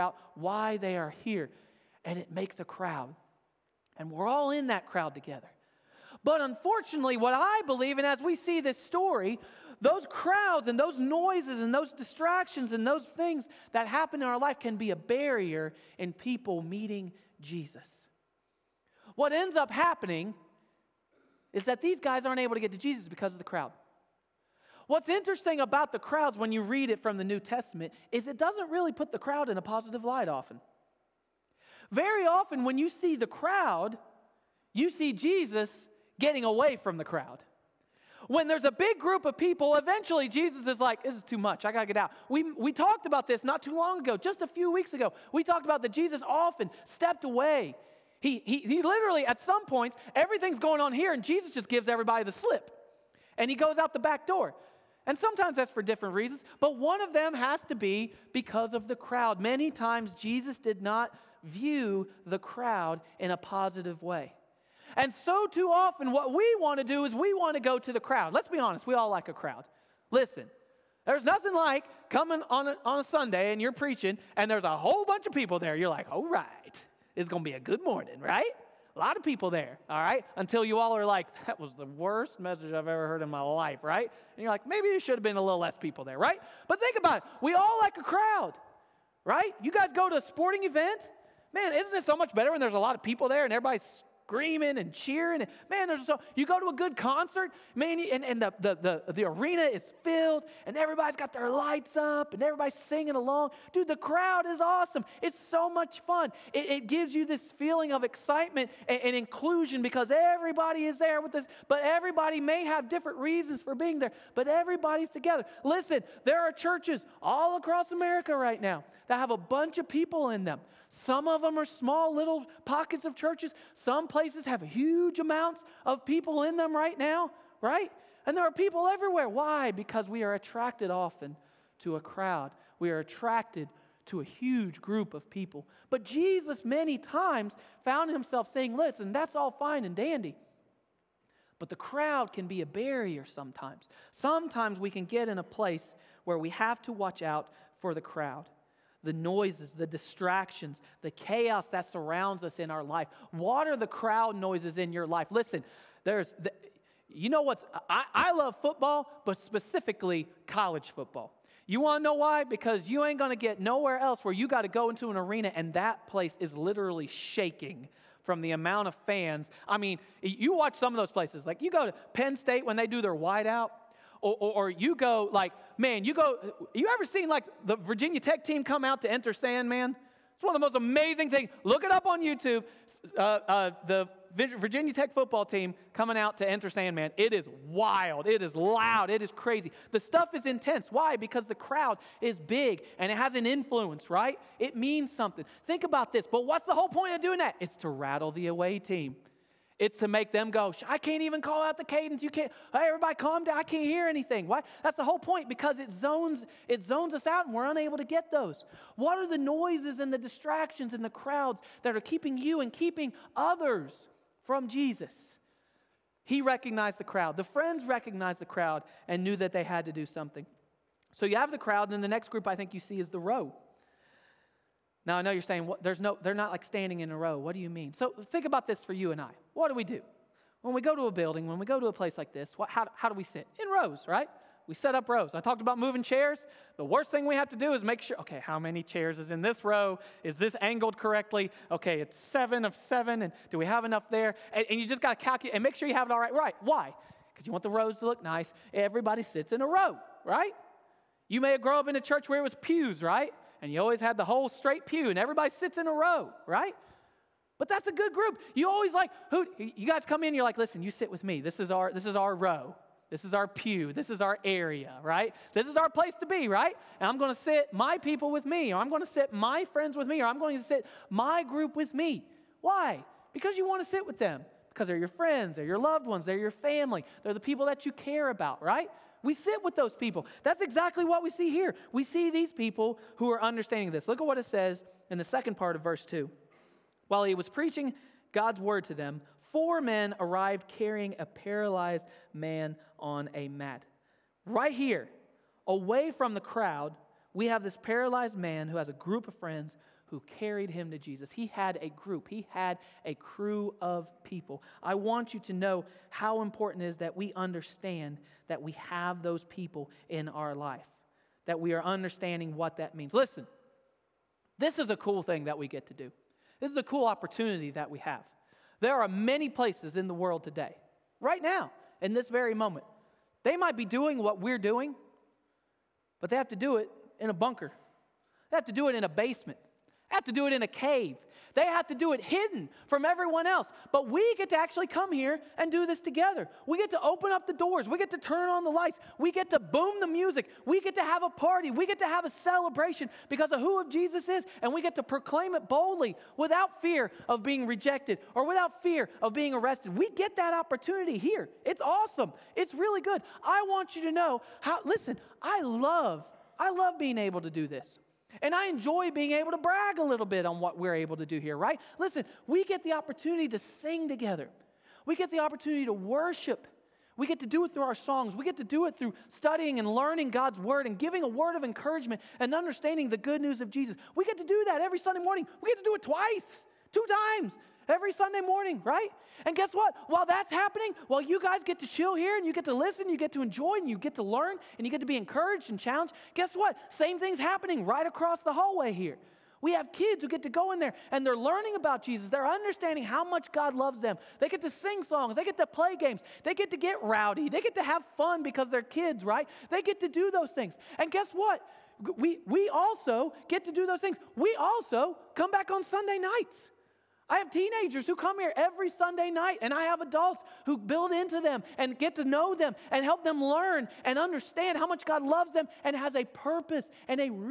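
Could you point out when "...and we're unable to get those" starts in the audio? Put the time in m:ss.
3:27.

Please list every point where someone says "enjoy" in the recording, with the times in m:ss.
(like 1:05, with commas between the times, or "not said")
5:58, 6:23.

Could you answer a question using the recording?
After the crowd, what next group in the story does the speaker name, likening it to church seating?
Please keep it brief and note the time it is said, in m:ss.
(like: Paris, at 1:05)
the row, at 3:43.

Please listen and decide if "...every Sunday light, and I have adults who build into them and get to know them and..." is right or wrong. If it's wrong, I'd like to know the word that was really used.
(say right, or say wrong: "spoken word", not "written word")
wrong: "night", not "light".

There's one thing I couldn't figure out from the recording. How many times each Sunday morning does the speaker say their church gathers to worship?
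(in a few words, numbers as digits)
2.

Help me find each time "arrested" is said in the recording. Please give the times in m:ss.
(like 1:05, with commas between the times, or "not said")
5:49.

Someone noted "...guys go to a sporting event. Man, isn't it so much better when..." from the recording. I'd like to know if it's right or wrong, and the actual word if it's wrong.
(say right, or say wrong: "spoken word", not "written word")
right.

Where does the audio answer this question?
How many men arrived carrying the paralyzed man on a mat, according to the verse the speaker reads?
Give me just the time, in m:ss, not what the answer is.
4:49.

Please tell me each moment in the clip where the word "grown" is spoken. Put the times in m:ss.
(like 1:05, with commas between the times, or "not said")
4:11.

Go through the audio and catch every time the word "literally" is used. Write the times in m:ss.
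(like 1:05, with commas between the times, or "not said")
0:48, 2:46.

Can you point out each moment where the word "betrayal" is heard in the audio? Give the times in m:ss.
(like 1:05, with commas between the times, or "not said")
not said.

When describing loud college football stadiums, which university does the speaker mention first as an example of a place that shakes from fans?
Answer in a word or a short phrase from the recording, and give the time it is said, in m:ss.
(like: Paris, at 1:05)
Penn State, at 2:52.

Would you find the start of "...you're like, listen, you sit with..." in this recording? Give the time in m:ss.
4:20.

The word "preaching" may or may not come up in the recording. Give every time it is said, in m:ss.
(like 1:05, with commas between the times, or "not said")
1:13, 4:47.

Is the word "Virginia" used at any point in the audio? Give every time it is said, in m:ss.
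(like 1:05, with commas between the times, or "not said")
2:57, 3:04.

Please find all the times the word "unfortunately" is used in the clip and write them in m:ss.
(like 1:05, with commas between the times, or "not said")
0:06.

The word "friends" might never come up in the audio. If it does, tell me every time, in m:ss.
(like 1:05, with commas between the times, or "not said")
3:37, 4:29, 4:35, 4:59.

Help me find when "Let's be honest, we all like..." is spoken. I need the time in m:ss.
1:08.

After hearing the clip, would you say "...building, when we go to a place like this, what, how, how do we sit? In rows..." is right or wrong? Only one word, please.
right.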